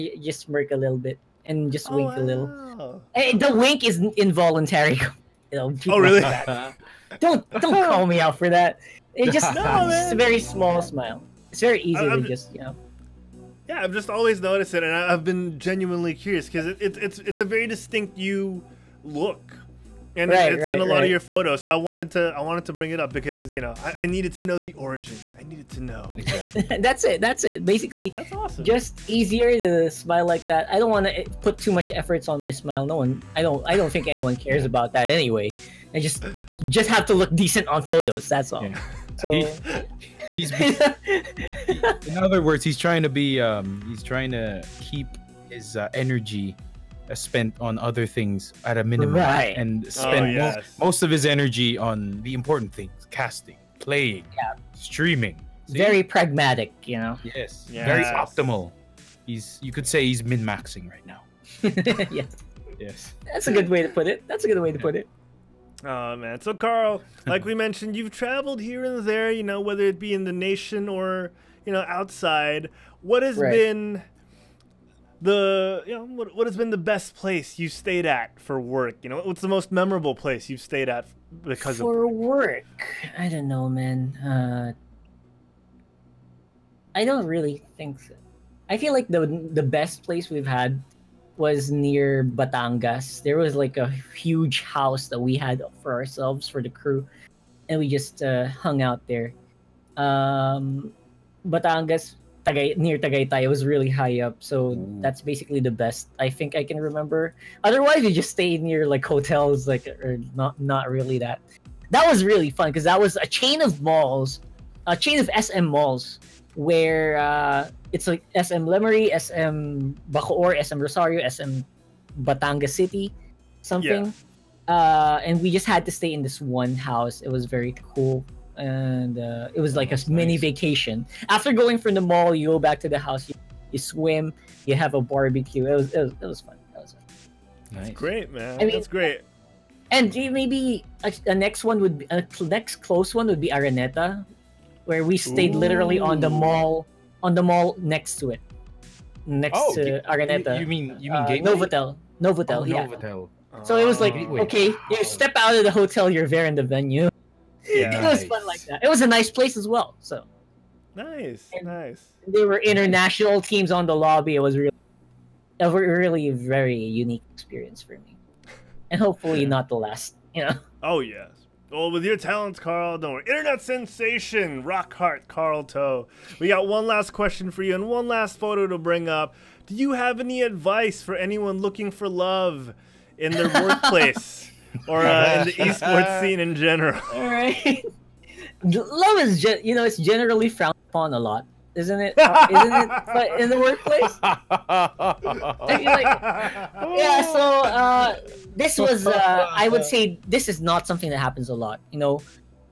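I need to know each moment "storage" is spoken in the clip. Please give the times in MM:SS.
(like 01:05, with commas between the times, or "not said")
not said.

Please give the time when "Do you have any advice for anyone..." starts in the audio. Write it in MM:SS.
02:59.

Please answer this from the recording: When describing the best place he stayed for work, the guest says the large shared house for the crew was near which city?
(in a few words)
Tagaytay.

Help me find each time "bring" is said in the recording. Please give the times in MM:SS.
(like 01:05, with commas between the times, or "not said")
00:22, 02:58.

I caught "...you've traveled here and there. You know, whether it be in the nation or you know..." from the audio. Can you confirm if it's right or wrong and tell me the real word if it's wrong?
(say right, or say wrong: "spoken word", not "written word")
right.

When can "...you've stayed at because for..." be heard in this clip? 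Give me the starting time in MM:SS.
01:20.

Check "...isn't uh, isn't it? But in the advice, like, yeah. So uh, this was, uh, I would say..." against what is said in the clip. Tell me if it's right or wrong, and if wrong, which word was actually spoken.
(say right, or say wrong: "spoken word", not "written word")
wrong: "workplace", not "advice".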